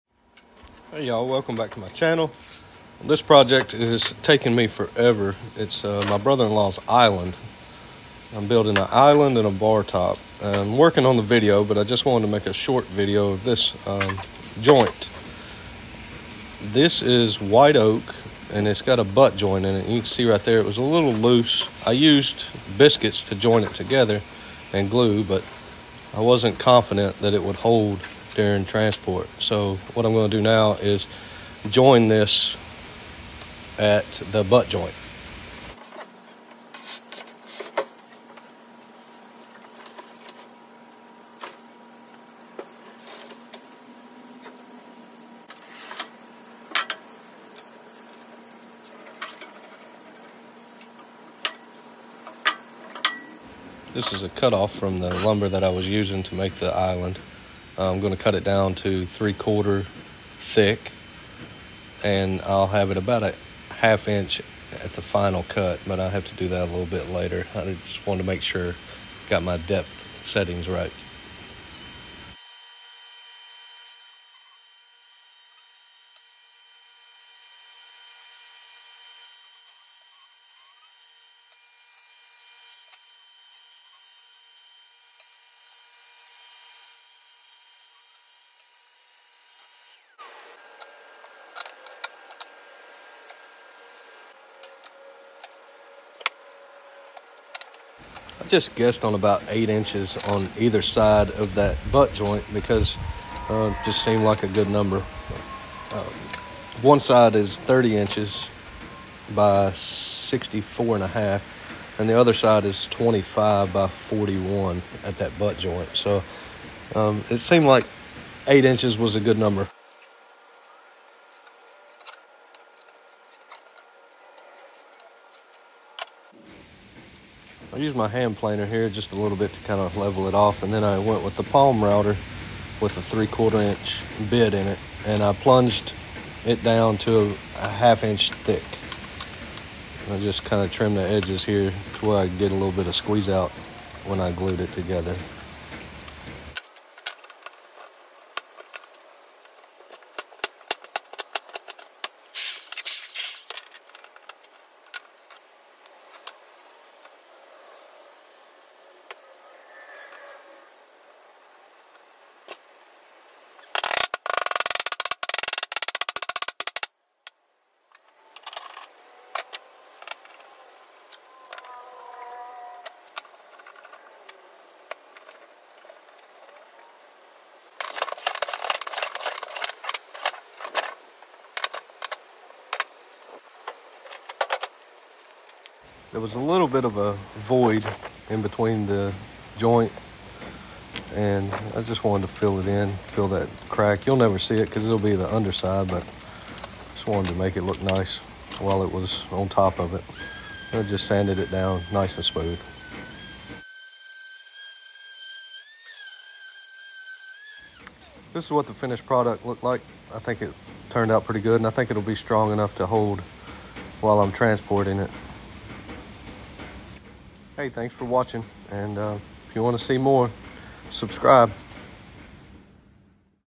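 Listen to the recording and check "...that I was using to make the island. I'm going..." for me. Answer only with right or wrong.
right.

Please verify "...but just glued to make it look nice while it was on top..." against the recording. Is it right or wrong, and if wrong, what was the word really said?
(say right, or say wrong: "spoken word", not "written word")
wrong: "wanted", not "glued".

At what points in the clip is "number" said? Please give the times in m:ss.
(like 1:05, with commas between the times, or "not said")
1:44, 1:59.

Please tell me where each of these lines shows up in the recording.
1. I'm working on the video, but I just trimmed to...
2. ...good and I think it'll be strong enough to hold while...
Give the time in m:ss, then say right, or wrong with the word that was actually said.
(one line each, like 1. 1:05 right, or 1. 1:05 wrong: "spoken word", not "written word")
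1. 0:10 wrong: "wanted", not "trimmed"
2. 3:31 right.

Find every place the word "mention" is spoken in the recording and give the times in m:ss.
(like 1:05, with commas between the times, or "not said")
not said.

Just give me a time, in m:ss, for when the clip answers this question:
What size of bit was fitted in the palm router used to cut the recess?
2:13.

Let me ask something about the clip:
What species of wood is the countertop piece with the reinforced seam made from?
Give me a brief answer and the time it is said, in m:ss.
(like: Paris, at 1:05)
white oak, at 0:17.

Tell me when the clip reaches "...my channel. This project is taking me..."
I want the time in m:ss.
0:01.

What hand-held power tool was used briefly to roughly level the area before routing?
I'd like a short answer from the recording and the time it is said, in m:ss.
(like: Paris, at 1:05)
hand planer, at 2:08.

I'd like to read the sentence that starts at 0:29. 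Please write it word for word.
So what I'm going to do now is join this at the butt joint.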